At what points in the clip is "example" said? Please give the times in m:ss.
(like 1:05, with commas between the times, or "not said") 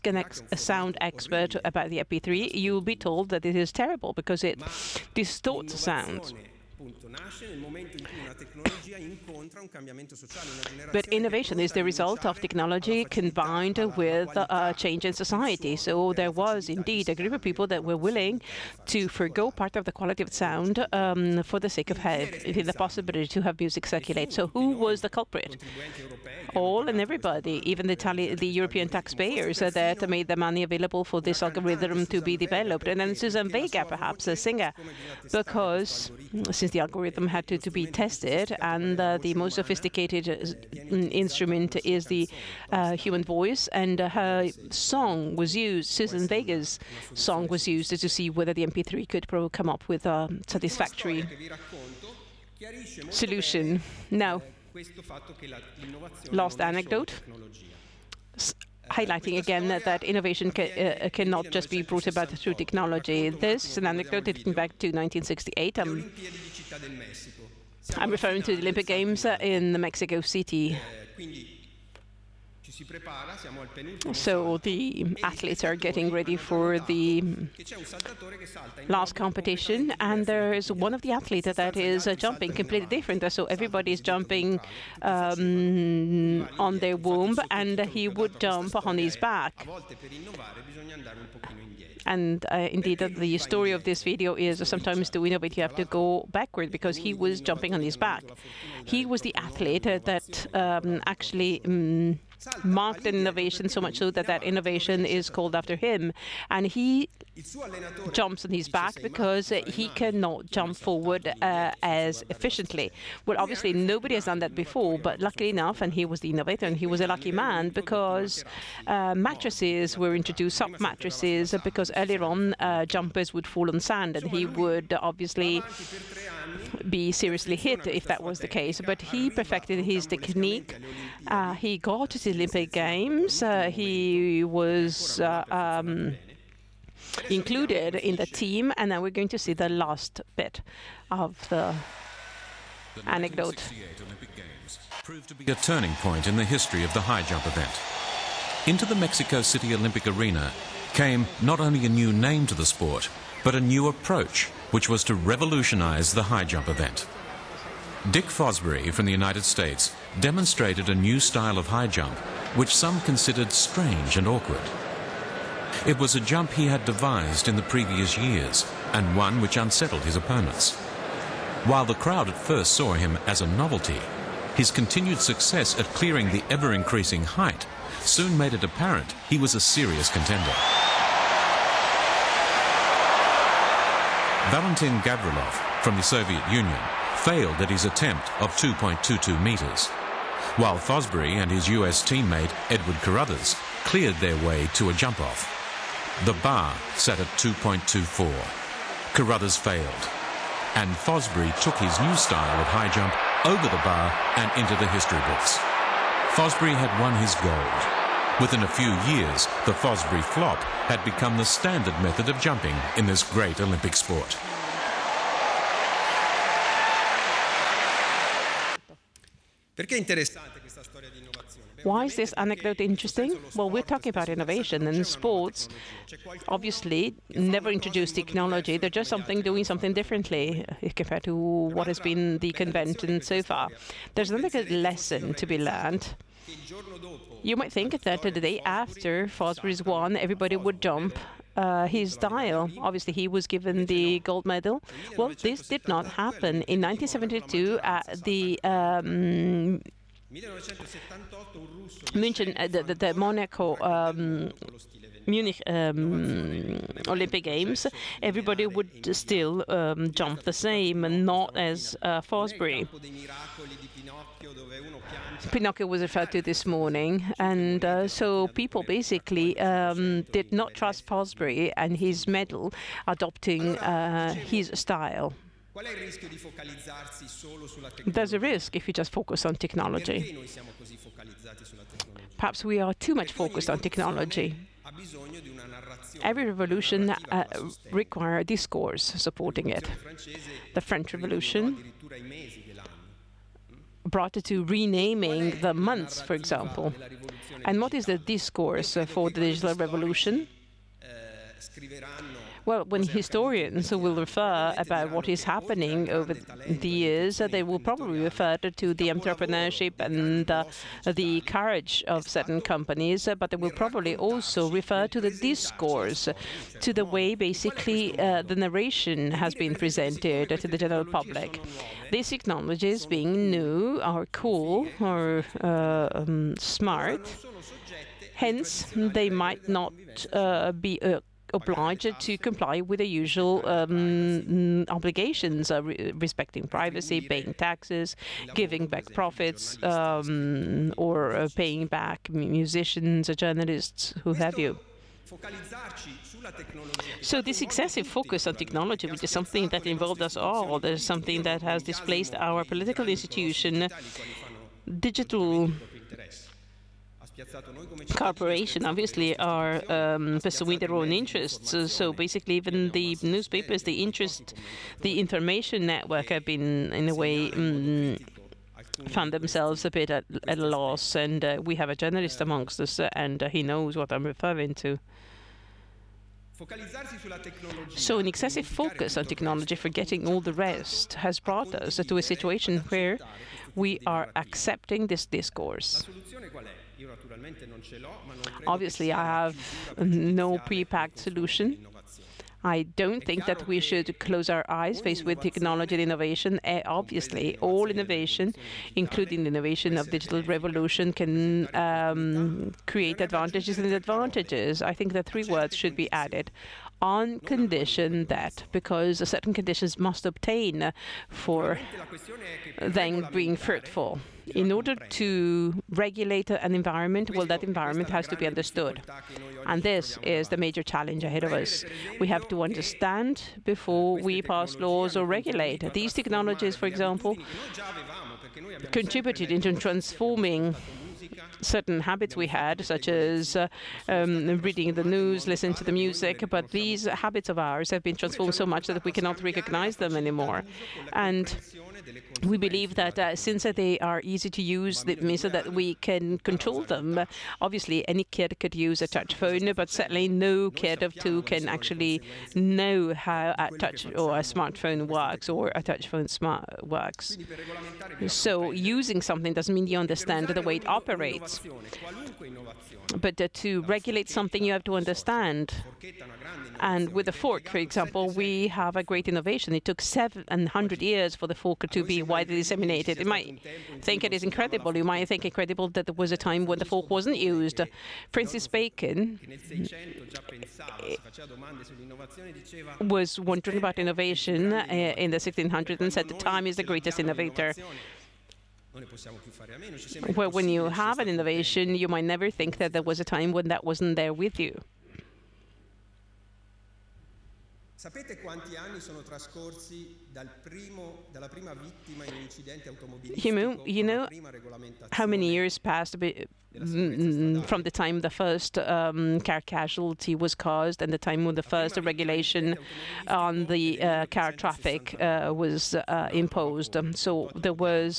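4:56, 7:06, 7:47.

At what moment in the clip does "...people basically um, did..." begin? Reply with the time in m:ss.
4:28.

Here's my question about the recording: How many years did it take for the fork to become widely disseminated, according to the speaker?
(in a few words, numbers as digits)
700.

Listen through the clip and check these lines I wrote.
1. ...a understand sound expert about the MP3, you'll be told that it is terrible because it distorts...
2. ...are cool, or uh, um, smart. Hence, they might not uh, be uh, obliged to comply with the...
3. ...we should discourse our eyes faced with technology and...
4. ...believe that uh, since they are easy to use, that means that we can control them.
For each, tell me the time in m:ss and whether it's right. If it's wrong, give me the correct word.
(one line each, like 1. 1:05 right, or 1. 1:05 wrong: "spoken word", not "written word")
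1. 0:00 wrong: "sound", not "understand"
2. 5:24 right
3. 6:33 wrong: "close", not "discourse"
4. 7:22 right.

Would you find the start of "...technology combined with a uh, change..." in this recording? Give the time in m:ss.
0:12.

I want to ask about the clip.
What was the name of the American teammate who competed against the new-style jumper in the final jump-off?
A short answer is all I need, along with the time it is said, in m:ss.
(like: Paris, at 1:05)
Edward Caruthers, at 3:12.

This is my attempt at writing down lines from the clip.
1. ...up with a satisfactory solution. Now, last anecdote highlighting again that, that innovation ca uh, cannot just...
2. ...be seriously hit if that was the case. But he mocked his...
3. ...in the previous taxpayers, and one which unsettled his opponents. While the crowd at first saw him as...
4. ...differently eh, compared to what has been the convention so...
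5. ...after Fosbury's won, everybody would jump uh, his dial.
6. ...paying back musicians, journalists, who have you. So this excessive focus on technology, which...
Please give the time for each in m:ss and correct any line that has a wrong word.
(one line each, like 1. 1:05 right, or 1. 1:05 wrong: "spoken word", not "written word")
1. 0:49 right
2. 2:06 wrong: "perfected", not "mocked"
3. 2:47 wrong: "years", not "taxpayers"
4. 3:49 right
5. 3:58 right
6. 5:41 right.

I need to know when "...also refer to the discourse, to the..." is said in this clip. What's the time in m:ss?
5:14.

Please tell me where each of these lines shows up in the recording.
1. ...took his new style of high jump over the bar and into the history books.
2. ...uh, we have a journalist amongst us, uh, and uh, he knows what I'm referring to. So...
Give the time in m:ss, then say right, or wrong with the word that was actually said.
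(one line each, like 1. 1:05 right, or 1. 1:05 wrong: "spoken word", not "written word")
1. 3:21 right
2. 6:11 right.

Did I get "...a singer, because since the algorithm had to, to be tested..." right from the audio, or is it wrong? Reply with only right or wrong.
right.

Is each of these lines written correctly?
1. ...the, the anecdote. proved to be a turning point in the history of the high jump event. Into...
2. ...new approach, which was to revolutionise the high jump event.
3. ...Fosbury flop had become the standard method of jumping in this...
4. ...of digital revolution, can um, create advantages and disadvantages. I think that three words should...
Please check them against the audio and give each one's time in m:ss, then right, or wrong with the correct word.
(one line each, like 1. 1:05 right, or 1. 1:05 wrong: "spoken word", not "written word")
1. 2:21 right
2. 2:33 right
3. 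3:29 right
4. 6:39 right.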